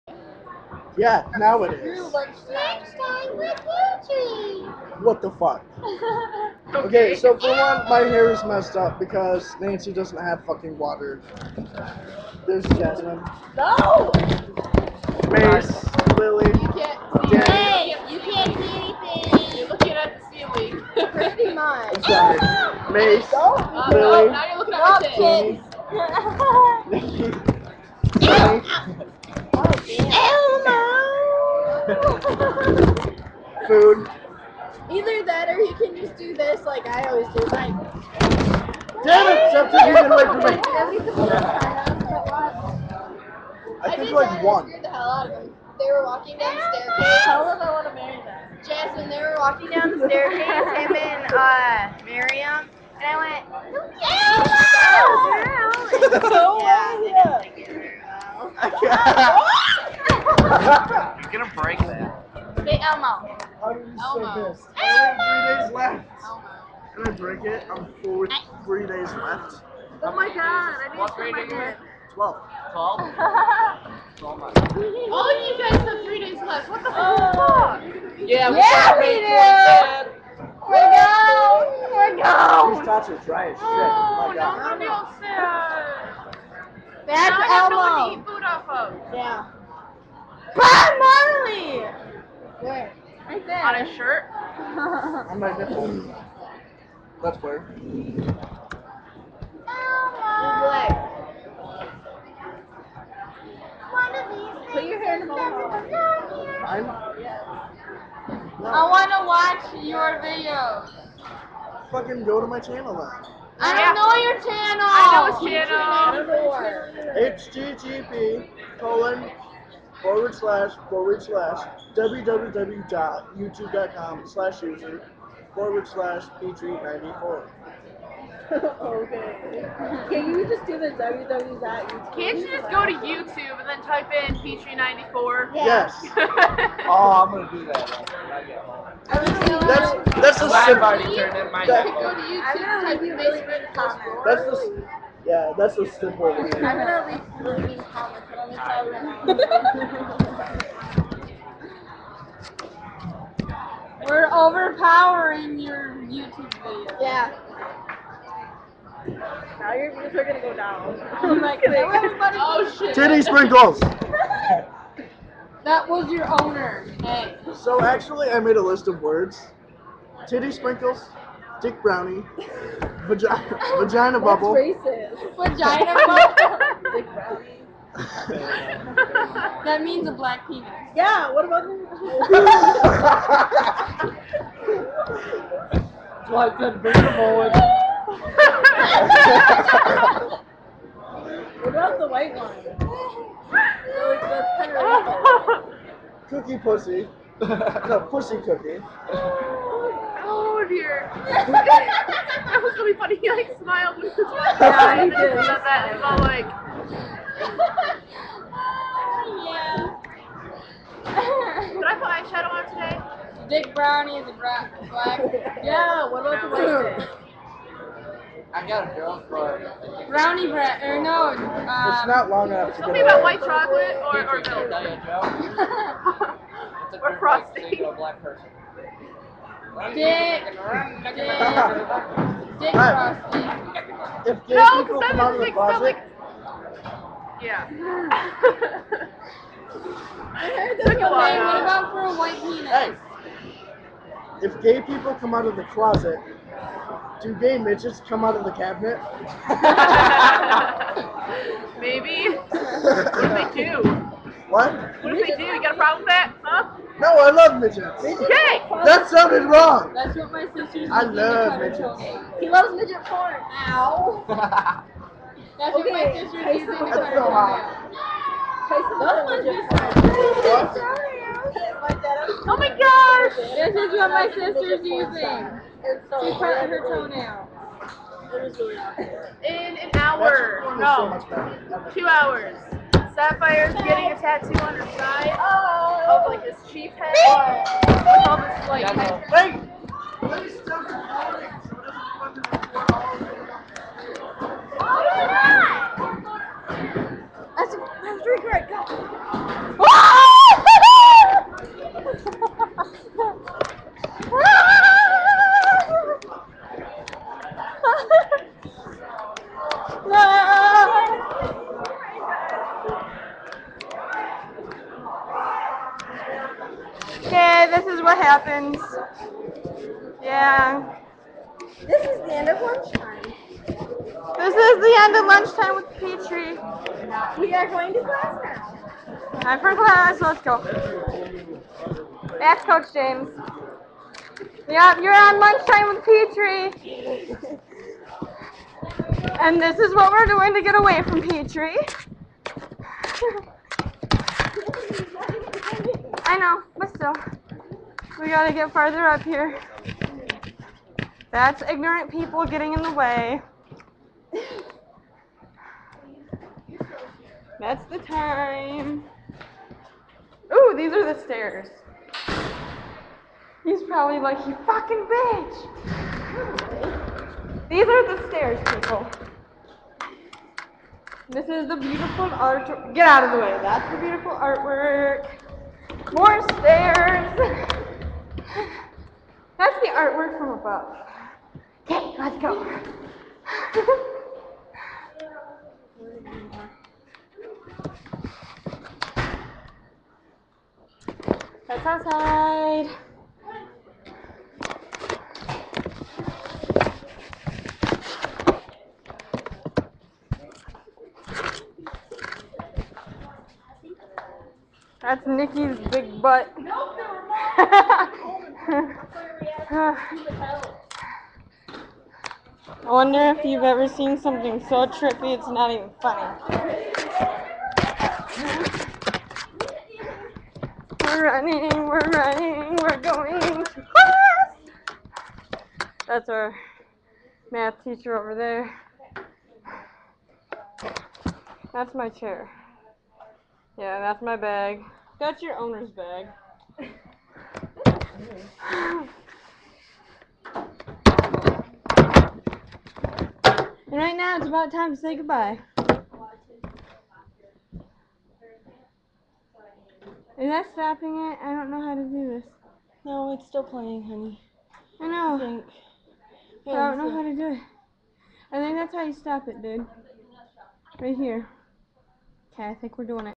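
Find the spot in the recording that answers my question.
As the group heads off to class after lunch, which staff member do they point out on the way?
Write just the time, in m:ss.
5:32.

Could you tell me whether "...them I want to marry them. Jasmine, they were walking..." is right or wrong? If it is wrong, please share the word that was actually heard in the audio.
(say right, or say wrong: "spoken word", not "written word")
right.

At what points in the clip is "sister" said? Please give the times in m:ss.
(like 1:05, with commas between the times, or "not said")
4:20, 4:26, 4:34.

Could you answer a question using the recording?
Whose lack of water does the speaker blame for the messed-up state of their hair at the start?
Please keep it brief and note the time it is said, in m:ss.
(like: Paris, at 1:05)
Nancy, at 0:09.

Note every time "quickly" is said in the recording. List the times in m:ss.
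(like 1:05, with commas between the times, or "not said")
not said.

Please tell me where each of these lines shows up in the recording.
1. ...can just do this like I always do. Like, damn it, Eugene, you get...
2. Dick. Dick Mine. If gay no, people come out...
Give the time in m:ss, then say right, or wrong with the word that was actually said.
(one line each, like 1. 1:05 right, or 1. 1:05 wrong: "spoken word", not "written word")
1. 0:35 wrong: "Scepter", not "Eugene"
2. 3:49 wrong: "Frosty", not "Mine".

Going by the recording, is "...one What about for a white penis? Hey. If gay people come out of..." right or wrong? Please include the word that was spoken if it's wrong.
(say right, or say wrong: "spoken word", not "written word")
right.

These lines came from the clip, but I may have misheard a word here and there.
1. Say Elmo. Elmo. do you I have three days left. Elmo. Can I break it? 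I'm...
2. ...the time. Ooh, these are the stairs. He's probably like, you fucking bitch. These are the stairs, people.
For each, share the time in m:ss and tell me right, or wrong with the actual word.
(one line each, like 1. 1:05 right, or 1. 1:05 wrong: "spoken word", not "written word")
1. 1:02 right
2. 5:57 right.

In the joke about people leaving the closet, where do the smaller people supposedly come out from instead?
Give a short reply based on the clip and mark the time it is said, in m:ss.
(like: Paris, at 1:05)
The cabinet, at 4:08.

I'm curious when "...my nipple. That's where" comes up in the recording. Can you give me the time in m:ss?
1:35.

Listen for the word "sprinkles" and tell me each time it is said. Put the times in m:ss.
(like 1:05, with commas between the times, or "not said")
2:43, 2:50.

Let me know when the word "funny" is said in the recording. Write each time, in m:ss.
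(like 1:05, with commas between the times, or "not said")
3:22, 6:55.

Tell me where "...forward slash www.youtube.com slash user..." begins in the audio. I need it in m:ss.
2:00.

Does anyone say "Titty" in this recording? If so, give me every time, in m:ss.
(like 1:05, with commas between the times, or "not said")
2:42, 2:50.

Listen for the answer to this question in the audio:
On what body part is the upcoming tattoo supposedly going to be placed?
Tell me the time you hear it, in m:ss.
4:44.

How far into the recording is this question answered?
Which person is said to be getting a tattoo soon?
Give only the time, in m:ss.
4:43.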